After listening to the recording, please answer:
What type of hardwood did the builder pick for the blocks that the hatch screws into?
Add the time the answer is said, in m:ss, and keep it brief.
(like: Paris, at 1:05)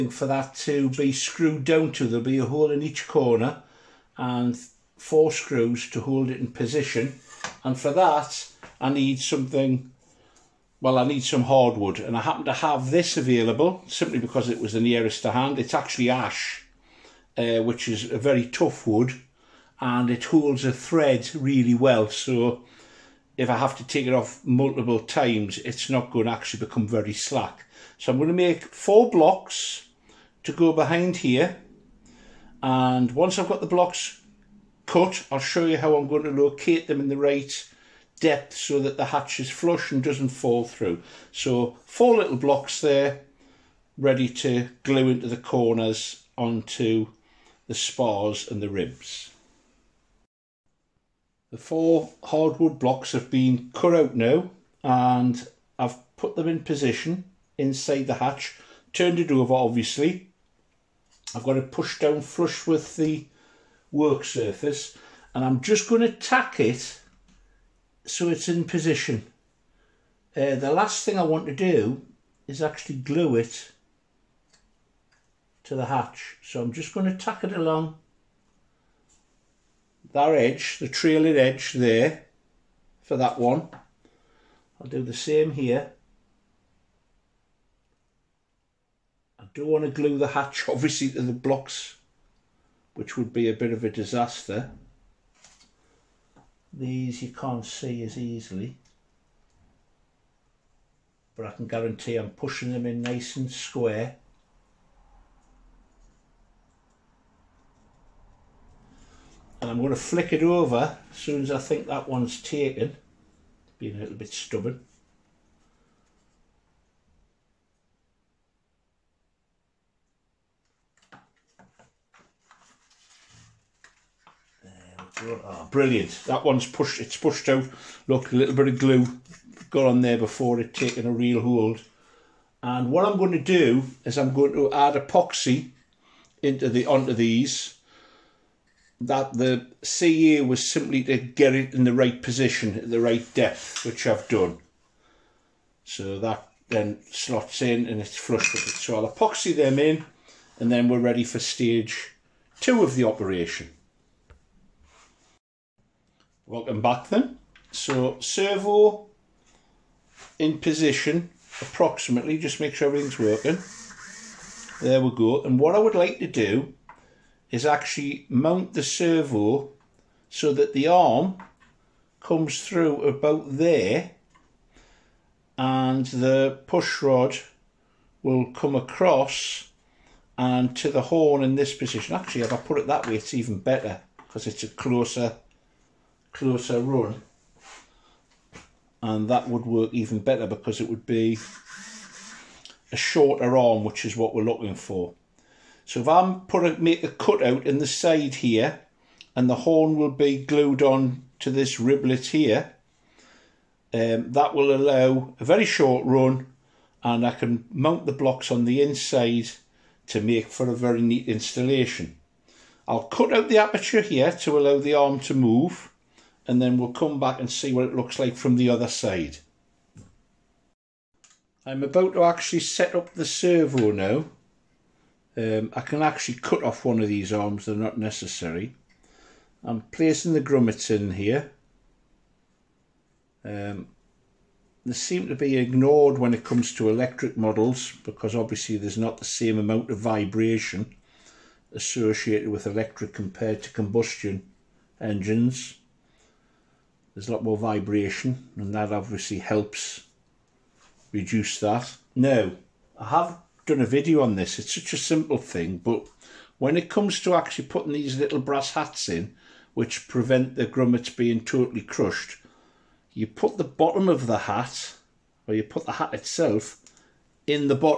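Ash, at 0:16.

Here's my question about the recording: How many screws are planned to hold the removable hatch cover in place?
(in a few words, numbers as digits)
4.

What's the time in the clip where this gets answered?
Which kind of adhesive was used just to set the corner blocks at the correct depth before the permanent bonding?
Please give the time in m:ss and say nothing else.
2:19.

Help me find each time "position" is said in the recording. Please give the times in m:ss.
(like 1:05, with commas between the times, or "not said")
0:06, 0:56, 1:08, 2:22, 2:40, 3:01.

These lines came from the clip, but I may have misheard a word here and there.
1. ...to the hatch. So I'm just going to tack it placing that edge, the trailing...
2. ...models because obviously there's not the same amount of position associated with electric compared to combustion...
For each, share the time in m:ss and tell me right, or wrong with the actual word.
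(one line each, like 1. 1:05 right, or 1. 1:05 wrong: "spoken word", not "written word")
1. 1:15 wrong: "along", not "placing"
2. 3:57 wrong: "vibration", not "position".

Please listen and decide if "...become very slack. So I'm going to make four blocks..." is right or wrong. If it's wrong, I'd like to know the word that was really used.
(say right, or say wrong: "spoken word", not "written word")
right.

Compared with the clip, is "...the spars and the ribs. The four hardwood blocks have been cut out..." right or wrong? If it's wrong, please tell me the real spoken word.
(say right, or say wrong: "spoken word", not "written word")
right.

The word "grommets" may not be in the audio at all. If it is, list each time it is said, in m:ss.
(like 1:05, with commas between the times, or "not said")
3:50, 4:20.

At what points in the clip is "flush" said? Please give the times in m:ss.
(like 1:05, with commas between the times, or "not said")
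0:39, 1:02, 2:28.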